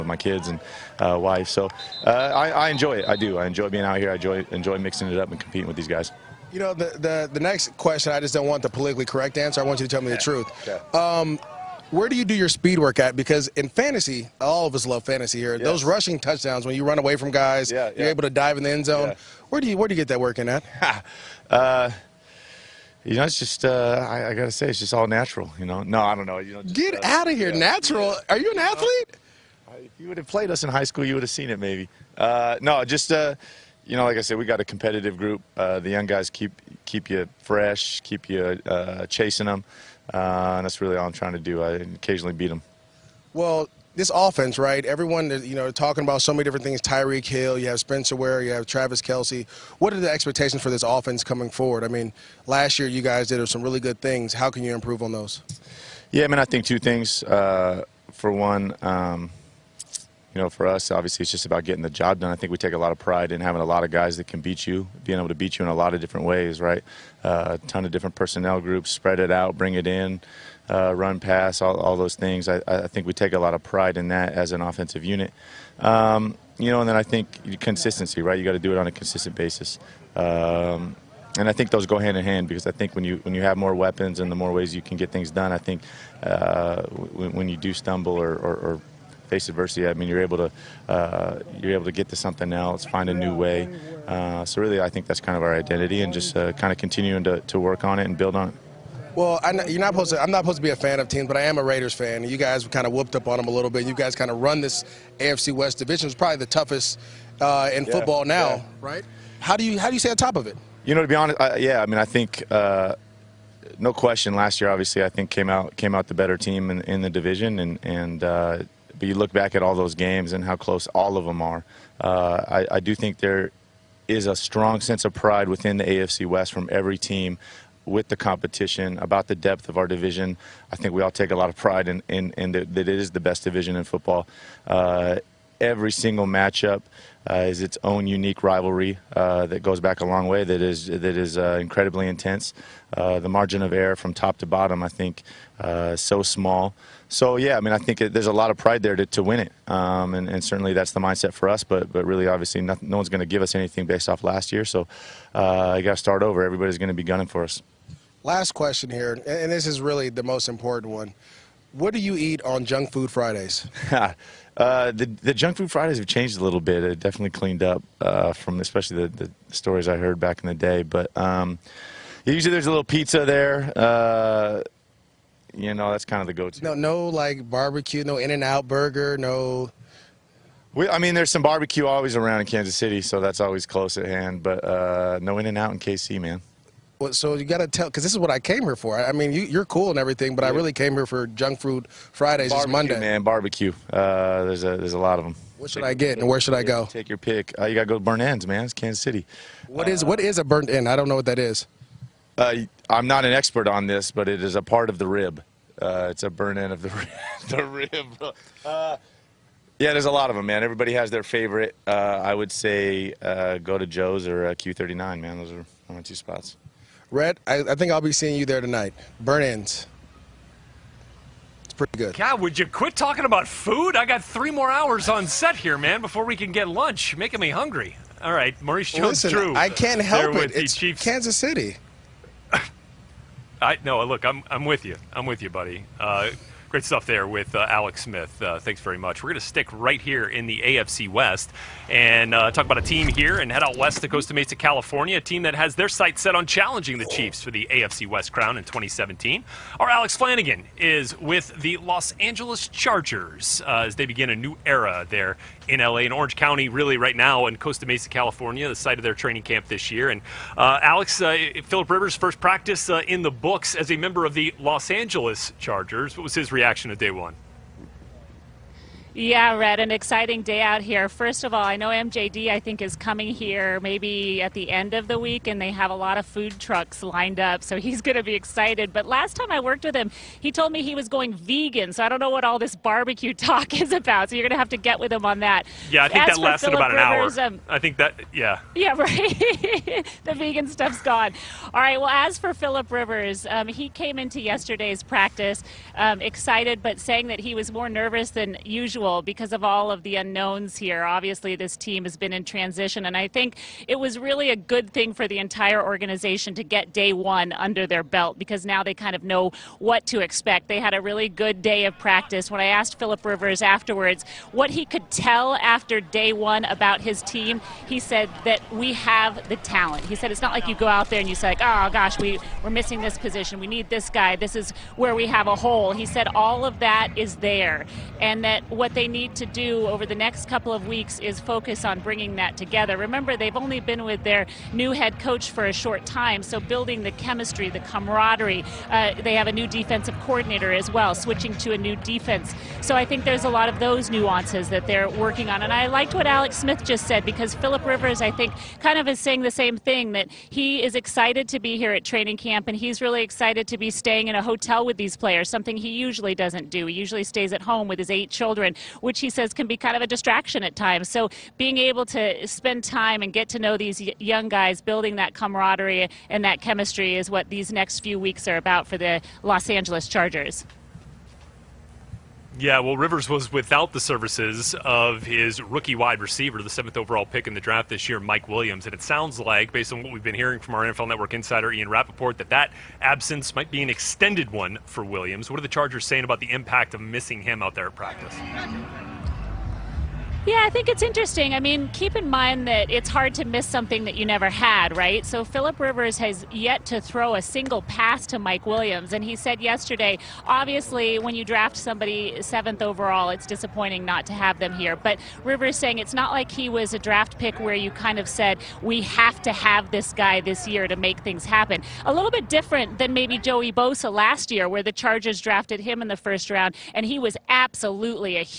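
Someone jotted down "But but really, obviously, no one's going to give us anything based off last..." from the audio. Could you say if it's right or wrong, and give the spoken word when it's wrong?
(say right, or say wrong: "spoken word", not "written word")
right.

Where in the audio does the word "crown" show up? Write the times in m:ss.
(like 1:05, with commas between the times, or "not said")
4:08.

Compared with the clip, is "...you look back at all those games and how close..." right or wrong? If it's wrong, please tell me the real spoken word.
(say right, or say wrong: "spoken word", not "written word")
right.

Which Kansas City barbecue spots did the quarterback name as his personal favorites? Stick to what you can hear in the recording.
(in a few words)
Joe's or Q39.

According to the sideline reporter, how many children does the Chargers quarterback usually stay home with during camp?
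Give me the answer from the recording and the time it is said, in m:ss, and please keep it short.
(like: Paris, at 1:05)
8, at 5:58.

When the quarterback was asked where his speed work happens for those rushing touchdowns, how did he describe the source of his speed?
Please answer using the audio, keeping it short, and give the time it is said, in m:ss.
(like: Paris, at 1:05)
all natural, at 0:24.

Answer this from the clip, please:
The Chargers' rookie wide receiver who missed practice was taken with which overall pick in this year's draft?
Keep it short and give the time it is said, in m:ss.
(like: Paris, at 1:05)
7th, at 6:16.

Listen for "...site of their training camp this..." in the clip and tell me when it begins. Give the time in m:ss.
4:18.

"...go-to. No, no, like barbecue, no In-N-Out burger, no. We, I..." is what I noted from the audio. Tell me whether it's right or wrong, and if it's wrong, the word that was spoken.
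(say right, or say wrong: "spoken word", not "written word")
right.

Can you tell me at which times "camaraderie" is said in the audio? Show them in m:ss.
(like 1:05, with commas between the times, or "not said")
5:37, 6:05.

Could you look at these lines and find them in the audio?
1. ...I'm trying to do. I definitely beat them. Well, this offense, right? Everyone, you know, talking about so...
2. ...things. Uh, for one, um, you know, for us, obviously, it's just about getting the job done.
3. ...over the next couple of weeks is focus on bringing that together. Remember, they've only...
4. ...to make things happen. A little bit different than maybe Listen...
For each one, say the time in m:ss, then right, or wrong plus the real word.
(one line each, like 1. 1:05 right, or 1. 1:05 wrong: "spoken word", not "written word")
1. 0:41 wrong: "occasionally", not "definitely"
2. 0:56 right
3. 5:29 right
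4. 6:50 wrong: "Joey", not "Listen".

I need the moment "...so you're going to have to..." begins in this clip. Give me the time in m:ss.
4:44.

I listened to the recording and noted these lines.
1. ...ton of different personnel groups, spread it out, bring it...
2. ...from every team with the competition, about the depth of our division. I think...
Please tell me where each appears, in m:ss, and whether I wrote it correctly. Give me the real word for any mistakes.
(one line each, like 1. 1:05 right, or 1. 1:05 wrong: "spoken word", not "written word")
1. 1:07 right
2. 2:06 right.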